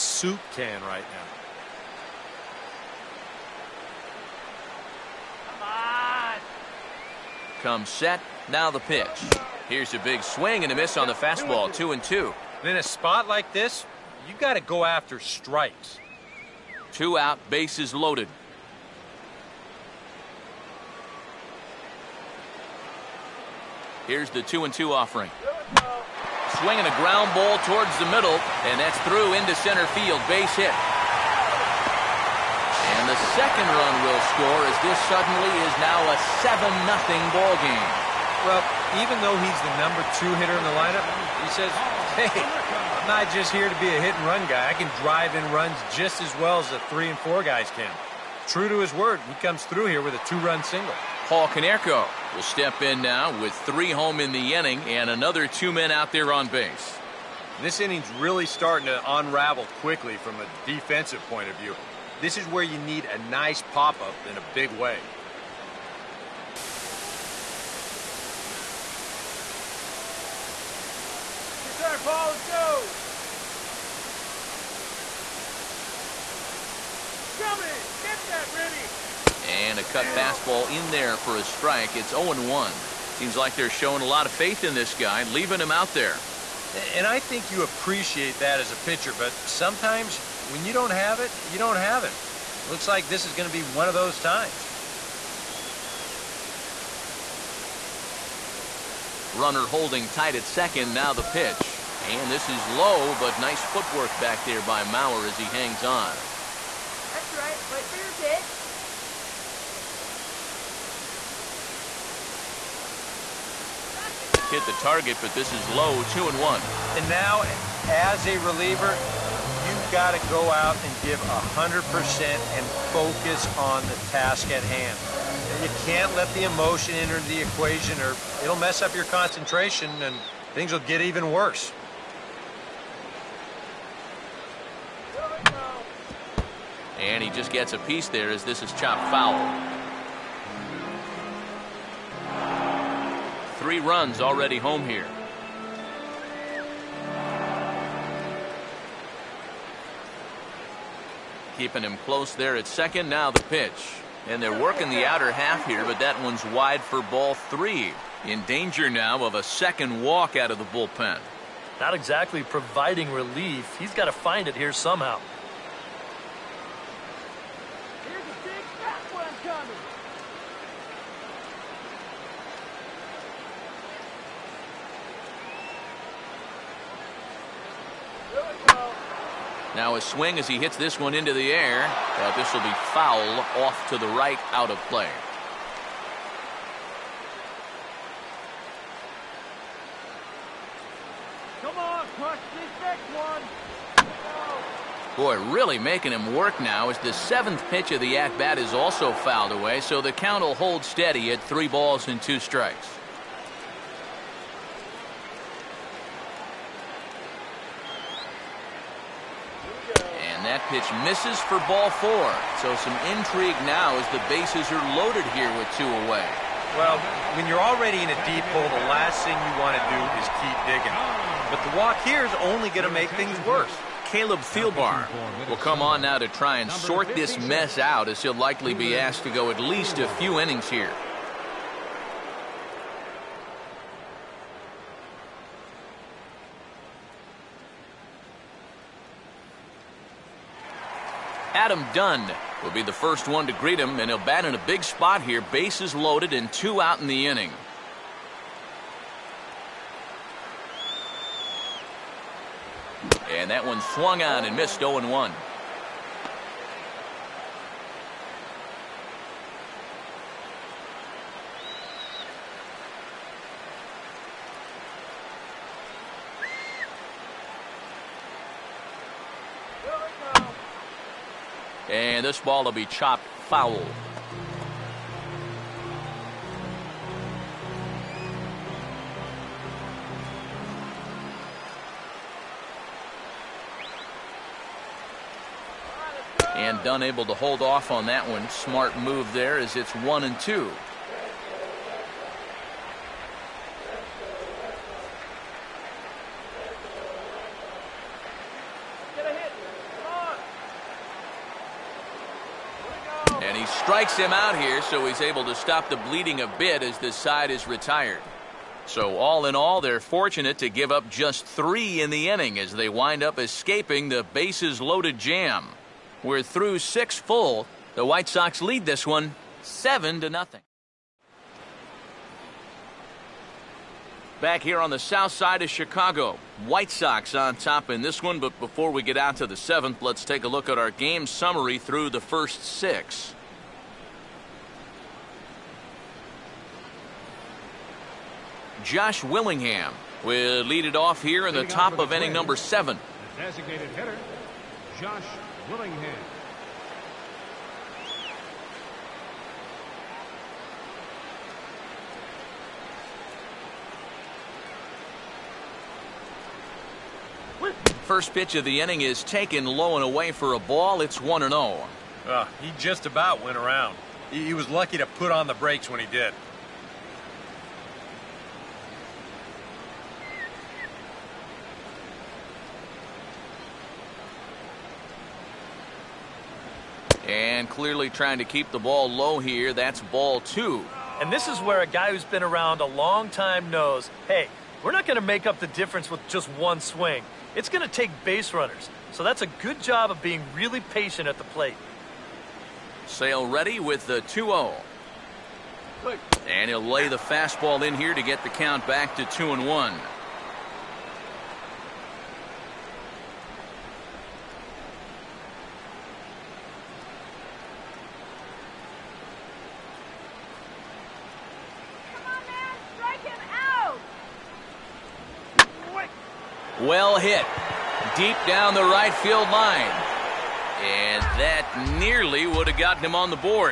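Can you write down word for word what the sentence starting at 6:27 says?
It's going to take base runners.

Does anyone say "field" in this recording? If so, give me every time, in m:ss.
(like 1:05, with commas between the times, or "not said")
0:29, 6:59.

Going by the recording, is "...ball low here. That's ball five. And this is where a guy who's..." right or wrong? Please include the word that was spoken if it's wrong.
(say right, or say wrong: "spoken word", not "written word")
wrong: "two", not "five".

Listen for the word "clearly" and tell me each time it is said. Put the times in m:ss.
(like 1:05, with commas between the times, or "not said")
6:17.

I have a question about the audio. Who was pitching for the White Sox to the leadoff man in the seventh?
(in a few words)
Sale.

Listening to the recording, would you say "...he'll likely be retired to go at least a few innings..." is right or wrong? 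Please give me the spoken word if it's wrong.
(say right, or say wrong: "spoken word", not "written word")
wrong: "asked", not "retired".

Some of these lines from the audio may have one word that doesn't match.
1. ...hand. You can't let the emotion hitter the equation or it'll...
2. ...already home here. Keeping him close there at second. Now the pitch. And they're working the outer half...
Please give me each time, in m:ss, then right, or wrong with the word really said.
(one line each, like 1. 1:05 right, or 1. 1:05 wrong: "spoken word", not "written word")
1. 2:04 wrong: "enter", not "hitter"
2. 2:24 right.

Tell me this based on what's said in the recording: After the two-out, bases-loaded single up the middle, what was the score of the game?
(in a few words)
7-0.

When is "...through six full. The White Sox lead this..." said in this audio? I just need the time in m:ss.
5:16.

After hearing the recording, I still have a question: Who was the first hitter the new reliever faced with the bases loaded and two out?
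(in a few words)
Adam Dunn.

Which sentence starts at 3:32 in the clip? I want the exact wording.
So some intrigue now as the bases are loaded here with two away.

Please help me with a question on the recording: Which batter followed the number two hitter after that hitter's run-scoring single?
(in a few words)
Paul Konerko.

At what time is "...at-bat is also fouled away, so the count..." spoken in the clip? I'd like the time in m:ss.
3:18.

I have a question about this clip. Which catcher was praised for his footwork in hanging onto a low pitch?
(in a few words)
Mauer.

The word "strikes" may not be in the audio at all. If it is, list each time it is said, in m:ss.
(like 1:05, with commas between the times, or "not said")
0:15, 1:21, 3:22, 5:03.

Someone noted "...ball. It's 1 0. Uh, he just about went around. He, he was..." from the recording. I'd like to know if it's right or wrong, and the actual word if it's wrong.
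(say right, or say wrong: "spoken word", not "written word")
right.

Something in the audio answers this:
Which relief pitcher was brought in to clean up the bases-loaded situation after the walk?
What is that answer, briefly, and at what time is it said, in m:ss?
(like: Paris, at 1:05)
Caleb Thielbar, at 3:44.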